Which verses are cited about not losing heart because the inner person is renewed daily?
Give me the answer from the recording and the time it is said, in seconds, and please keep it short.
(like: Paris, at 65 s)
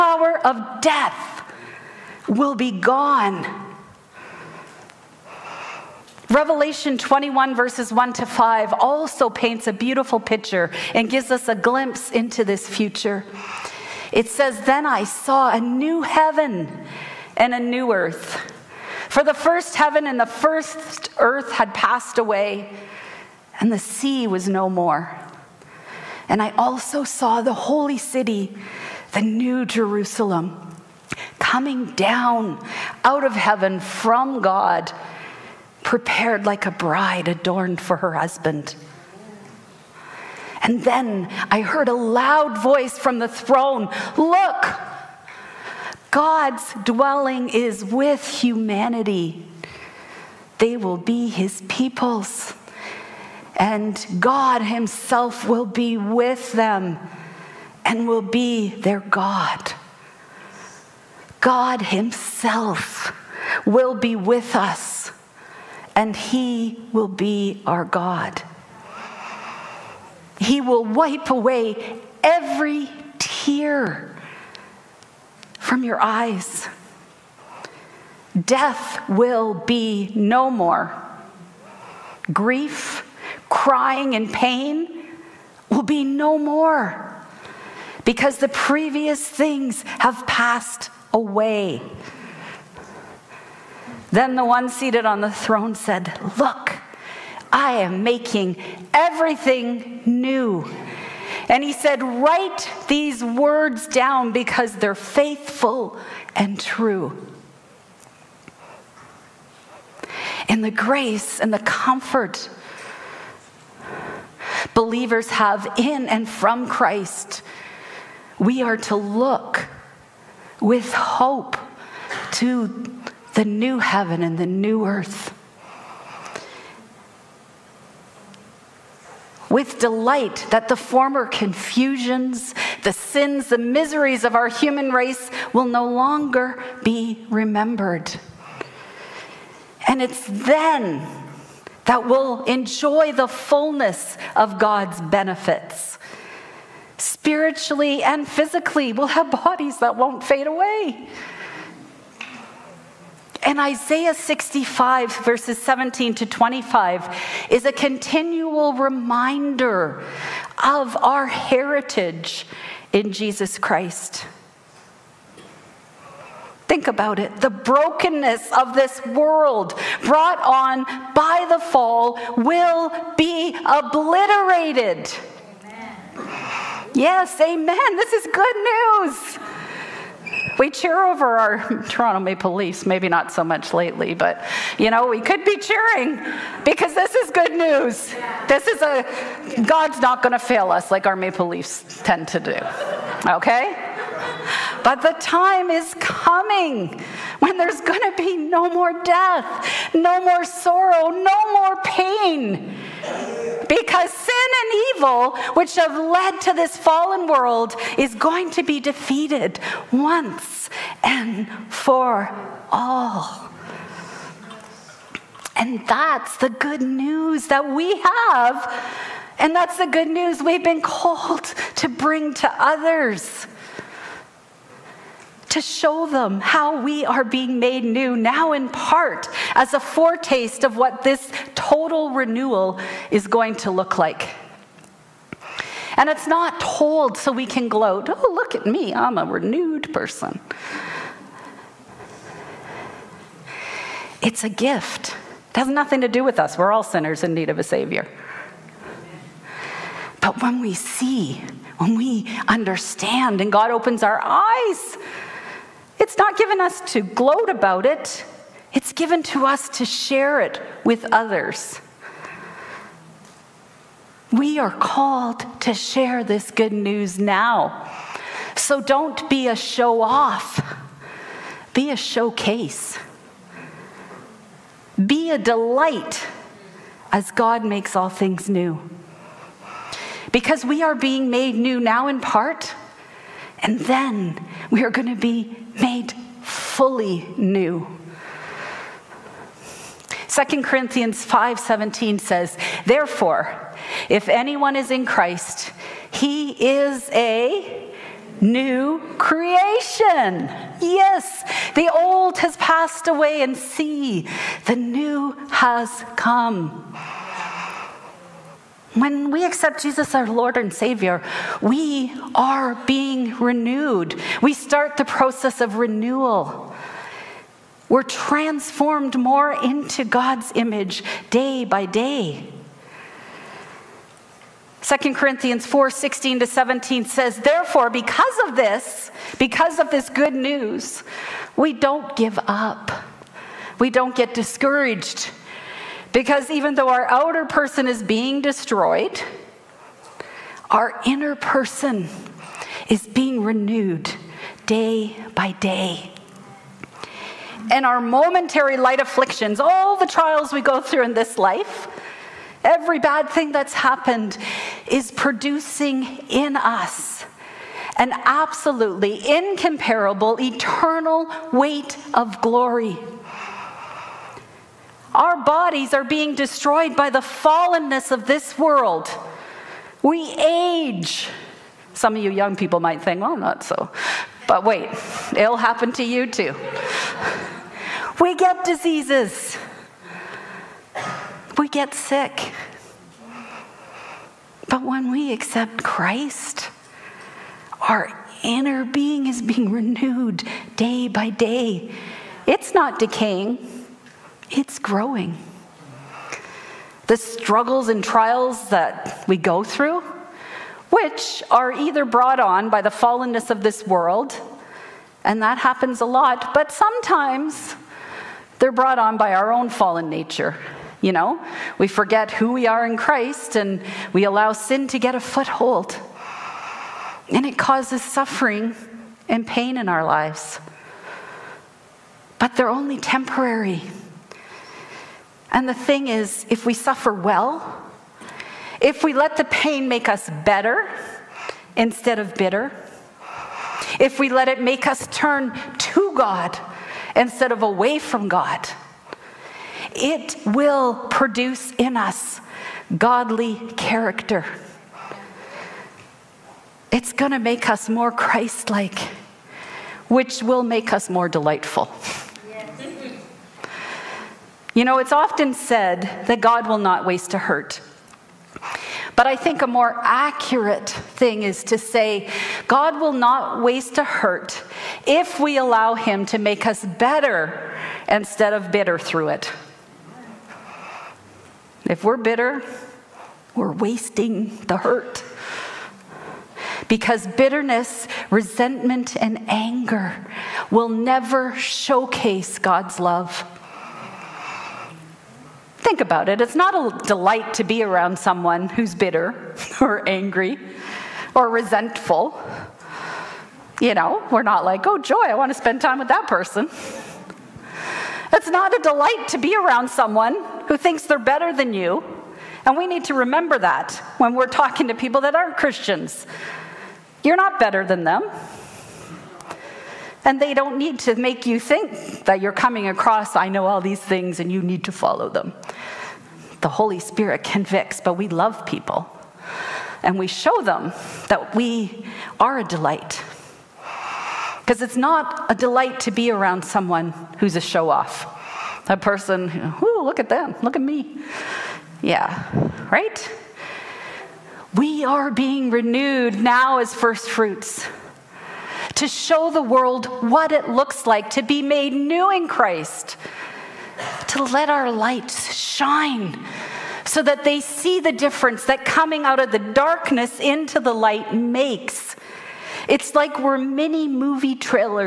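2 Corinthians 4:16-17, at 324 s.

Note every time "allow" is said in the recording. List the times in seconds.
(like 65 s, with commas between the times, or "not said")
414 s, 465 s.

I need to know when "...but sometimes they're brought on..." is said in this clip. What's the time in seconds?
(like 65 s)
406 s.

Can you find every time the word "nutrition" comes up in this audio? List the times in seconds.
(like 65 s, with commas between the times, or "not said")
not said.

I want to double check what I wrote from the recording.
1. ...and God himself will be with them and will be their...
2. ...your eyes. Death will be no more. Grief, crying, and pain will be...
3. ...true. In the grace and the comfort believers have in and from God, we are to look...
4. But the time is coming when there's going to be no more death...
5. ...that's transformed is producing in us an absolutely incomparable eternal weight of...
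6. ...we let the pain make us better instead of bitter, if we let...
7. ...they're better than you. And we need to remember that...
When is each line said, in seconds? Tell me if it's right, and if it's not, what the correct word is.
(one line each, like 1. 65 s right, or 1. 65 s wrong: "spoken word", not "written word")
1. 53 s right
2. 75 s right
3. 106 s wrong: "Christ", not "God"
4. 194 s right
5. 353 s wrong: "happened", not "transformed"
6. 429 s right
7. 501 s right.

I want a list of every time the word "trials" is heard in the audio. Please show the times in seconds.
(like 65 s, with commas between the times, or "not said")
350 s, 398 s.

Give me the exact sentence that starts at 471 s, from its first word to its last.
If we're bitter, we're wasting the hurt.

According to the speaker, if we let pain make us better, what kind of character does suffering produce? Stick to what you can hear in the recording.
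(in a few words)
Godly character.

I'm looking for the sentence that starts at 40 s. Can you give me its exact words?
And then I heard a loud voice from the throne Look!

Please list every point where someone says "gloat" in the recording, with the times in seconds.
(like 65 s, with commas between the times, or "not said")
237 s, 257 s.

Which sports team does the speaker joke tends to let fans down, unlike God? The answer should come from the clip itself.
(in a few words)
Toronto Maple Leafs.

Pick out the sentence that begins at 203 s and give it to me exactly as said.
Because sin and evil, which have led to this fallen world, is going to be defeated once and for all.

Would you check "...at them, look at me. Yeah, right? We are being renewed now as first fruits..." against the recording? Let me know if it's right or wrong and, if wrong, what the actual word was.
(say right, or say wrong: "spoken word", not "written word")
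right.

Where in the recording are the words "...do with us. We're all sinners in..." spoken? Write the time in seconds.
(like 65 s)
246 s.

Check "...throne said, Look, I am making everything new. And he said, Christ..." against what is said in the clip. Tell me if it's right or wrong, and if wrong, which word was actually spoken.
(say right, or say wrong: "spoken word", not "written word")
wrong: "Write", not "Christ".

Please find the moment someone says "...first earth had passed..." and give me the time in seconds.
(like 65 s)
20 s.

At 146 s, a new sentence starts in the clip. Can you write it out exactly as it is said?
Spiritually and physically, we'll have bodies that won't fade away.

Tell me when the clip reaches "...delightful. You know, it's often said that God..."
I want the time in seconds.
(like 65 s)
451 s.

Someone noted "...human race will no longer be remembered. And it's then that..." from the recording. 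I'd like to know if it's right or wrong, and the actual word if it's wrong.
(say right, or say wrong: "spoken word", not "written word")
right.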